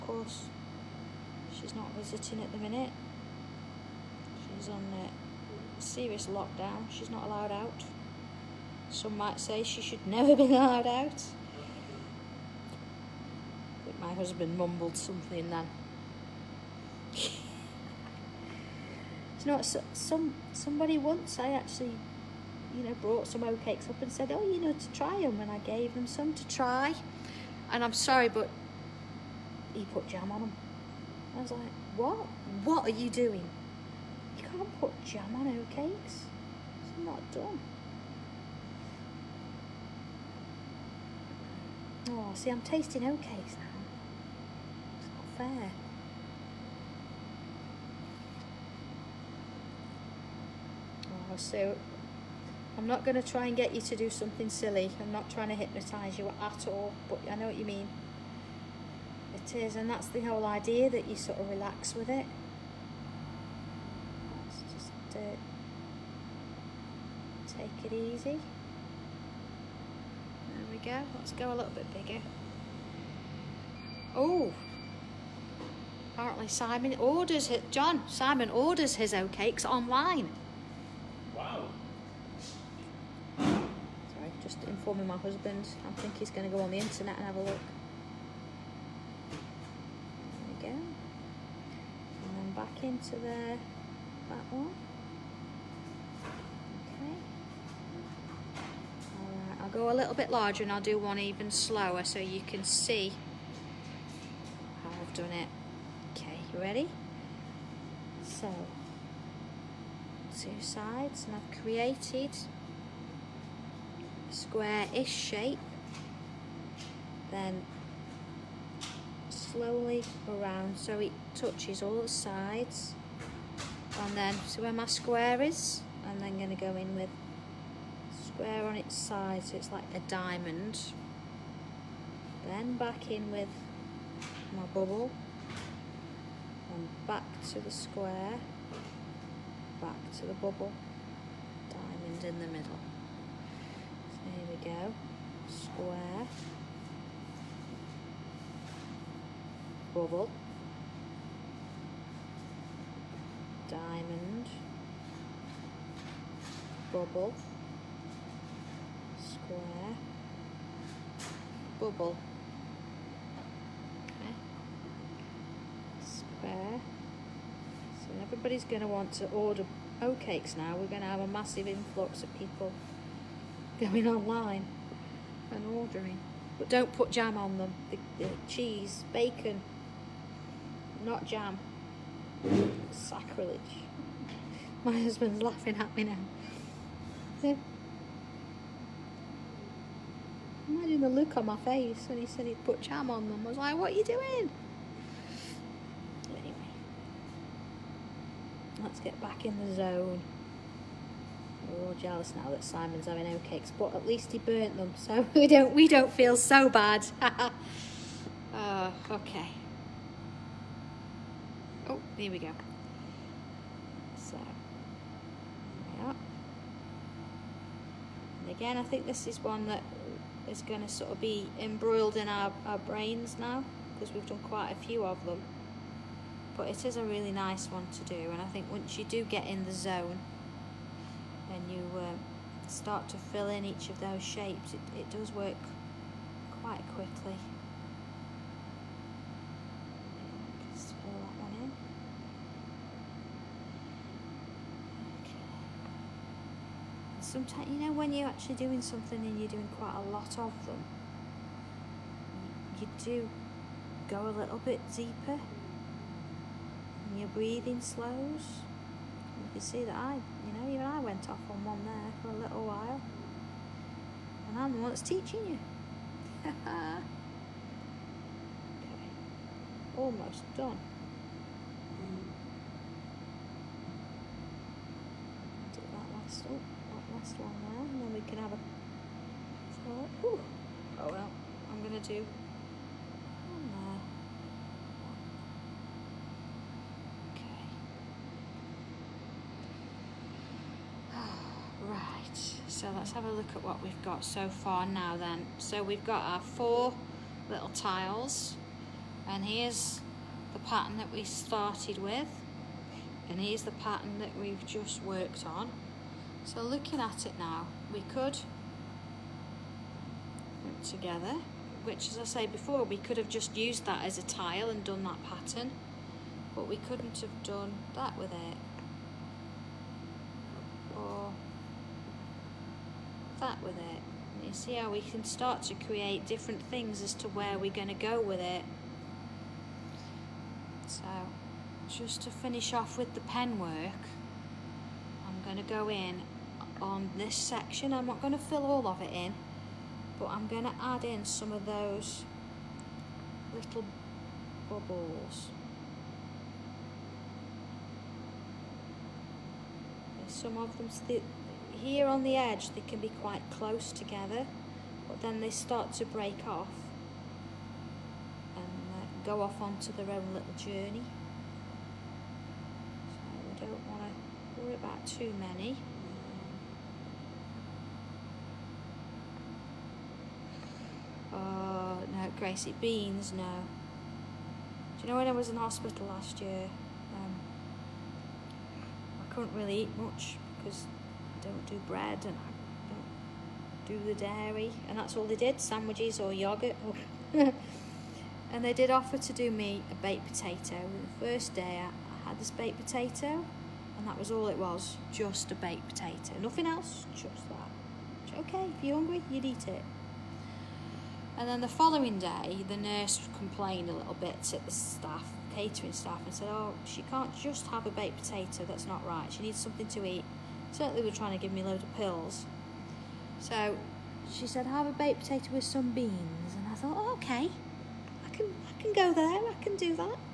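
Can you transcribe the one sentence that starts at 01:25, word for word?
I think he's going to go on the internet and have a look.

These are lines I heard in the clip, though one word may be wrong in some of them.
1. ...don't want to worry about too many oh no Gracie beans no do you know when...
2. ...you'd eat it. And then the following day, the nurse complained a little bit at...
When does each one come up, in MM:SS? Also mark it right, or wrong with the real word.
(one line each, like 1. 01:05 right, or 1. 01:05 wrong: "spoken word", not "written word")
1. 06:03 right
2. 06:39 right.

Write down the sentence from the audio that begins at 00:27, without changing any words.
And I'm sorry, but he put jam on them.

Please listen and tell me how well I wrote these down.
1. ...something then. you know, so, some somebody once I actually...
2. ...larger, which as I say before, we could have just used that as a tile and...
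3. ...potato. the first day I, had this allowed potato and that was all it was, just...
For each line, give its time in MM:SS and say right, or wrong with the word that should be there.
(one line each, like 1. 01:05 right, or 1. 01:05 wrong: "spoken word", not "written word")
1. 00:14 right
2. 05:10 wrong: "together", not "larger"
3. 06:30 wrong: "baked", not "allowed".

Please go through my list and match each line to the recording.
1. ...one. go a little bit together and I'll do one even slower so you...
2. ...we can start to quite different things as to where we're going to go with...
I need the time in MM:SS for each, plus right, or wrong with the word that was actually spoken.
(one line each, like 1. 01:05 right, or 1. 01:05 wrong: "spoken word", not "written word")
1. 01:34 wrong: "larger", not "together"
2. 05:24 wrong: "create", not "quite".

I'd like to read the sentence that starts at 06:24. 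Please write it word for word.
And that's all they did, sandwiches or yoghurt.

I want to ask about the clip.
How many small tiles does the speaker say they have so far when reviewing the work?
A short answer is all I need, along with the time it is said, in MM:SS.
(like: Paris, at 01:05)
4, at 04:56.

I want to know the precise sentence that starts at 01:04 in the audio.
Let's just uh, take it easy.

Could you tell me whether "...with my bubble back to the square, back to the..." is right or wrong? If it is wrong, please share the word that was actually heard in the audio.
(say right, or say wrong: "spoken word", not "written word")
right.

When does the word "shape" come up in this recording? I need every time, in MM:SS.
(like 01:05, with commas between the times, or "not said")
01:55, 03:54.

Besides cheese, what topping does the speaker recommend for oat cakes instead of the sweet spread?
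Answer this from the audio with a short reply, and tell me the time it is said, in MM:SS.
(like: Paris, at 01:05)
bacon, at 02:59.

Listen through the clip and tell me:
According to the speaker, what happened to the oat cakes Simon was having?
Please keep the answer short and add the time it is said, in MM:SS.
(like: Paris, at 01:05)
he burnt them, at 03:24.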